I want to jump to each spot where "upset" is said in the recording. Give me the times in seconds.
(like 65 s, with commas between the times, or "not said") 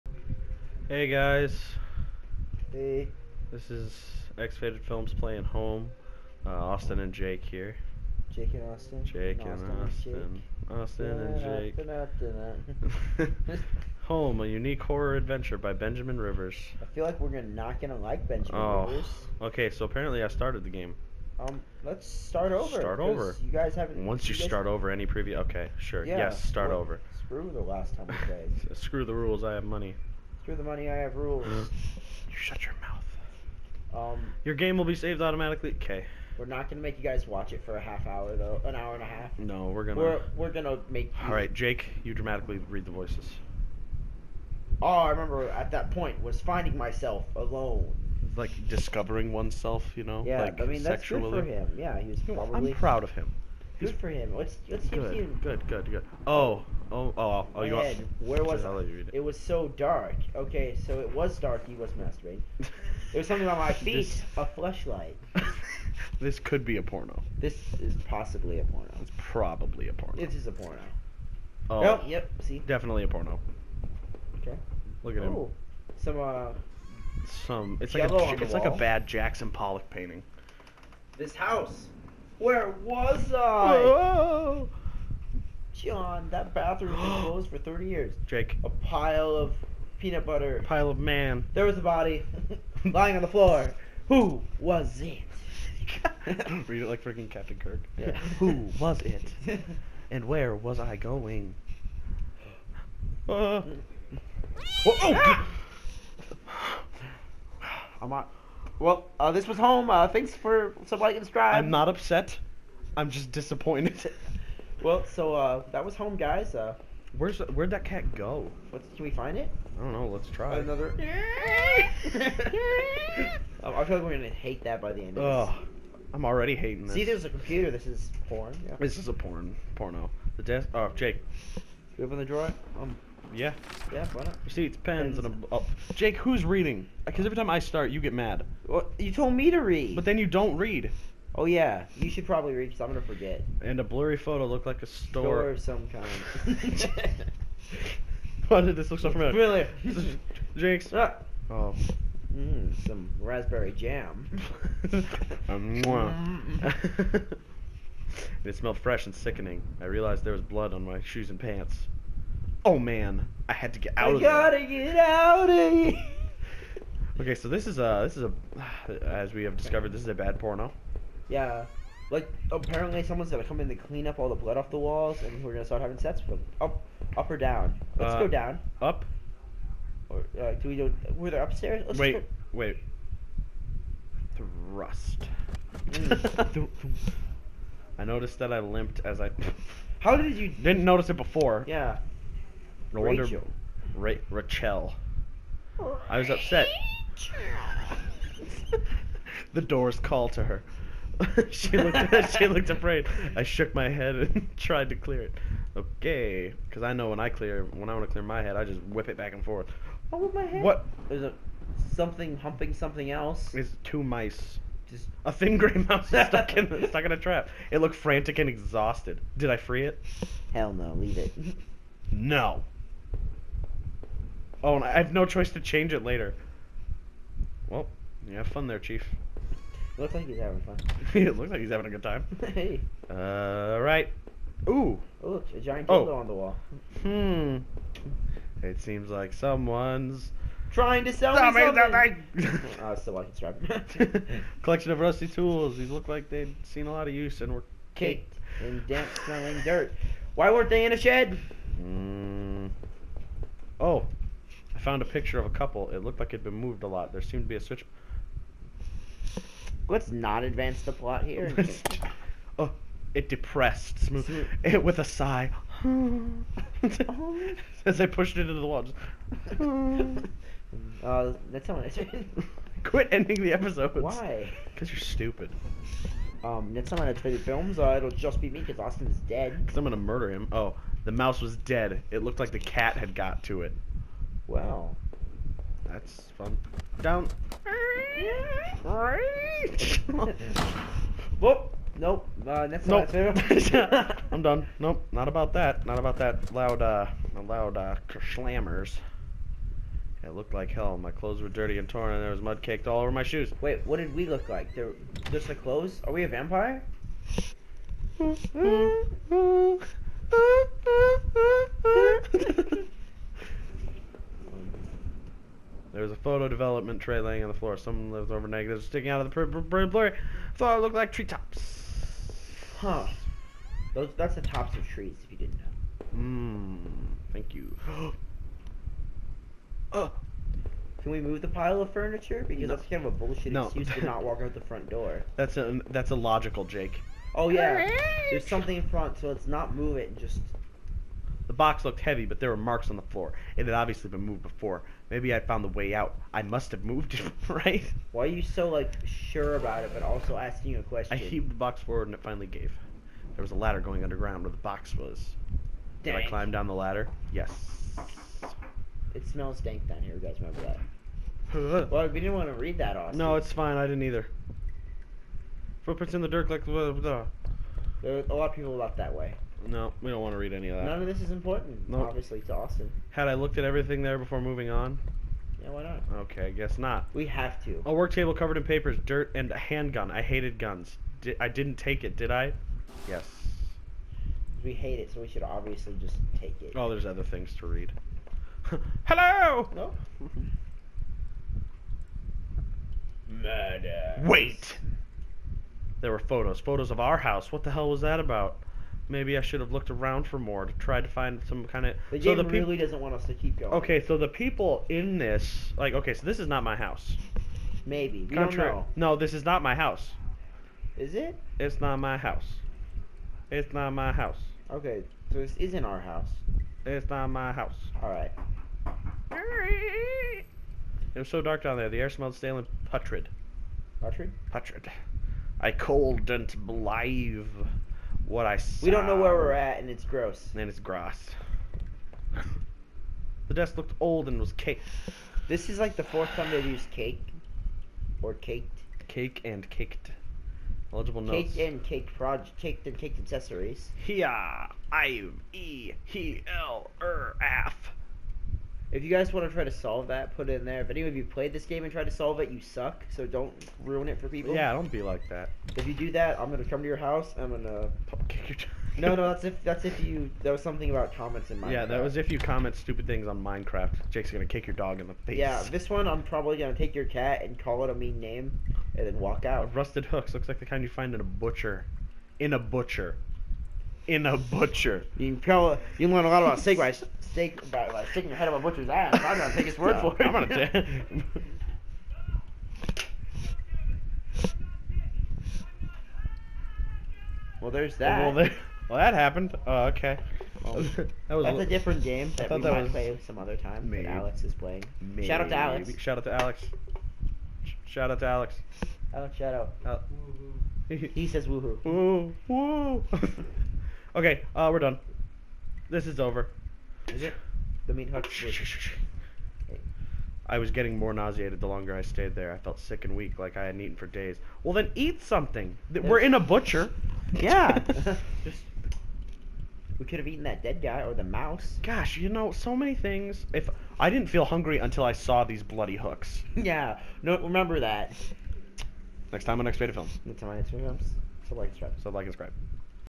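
111 s, 196 s.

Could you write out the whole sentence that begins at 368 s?
There a lot of people left that way.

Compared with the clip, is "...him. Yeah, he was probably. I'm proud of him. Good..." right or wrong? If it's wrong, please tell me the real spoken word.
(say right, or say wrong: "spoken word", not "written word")
right.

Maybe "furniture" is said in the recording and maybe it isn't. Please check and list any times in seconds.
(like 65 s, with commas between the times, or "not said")
331 s.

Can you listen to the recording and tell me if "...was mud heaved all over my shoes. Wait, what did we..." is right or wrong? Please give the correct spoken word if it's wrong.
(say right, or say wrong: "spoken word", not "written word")
wrong: "caked", not "heaved".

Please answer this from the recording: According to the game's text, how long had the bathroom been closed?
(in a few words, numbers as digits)
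30 years.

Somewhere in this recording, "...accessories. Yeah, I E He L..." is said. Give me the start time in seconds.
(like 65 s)
443 s.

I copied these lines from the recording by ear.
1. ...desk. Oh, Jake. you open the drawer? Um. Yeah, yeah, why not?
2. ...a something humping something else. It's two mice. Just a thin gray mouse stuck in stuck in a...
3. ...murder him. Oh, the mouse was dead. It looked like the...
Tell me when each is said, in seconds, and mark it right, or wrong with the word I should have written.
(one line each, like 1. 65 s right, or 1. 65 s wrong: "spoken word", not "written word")
1. 130 s right
2. 211 s right
3. 279 s right.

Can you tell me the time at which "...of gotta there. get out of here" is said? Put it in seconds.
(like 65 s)
164 s.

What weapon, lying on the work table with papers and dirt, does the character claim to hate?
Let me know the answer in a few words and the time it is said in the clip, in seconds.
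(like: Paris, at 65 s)
handgun, at 379 s.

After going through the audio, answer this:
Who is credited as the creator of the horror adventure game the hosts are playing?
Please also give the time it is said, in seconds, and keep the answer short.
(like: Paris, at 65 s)
Benjamin Rivers, at 15 s.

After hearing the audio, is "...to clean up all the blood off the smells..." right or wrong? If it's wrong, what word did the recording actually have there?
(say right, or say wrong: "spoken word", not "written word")
wrong: "walls", not "smells".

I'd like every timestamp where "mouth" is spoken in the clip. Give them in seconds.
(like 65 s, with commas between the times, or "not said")
32 s.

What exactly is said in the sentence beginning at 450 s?
If any of you played this game and tried to solve it, you suck.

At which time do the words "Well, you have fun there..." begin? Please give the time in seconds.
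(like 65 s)
227 s.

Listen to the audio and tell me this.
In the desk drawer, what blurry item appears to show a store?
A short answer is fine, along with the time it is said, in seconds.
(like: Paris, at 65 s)
a blurry photo, at 143 s.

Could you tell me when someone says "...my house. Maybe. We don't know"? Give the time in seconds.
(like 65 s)
406 s.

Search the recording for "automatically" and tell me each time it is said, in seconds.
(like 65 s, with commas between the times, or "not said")
35 s.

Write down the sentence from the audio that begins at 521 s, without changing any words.
Gosh, you know, so many things.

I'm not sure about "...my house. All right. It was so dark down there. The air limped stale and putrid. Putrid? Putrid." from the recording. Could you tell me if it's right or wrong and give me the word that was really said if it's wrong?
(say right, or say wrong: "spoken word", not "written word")
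wrong: "smelled", not "limped".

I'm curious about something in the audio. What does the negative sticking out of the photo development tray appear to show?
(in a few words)
treetops.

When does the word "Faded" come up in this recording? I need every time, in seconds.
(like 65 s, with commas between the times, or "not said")
4 s.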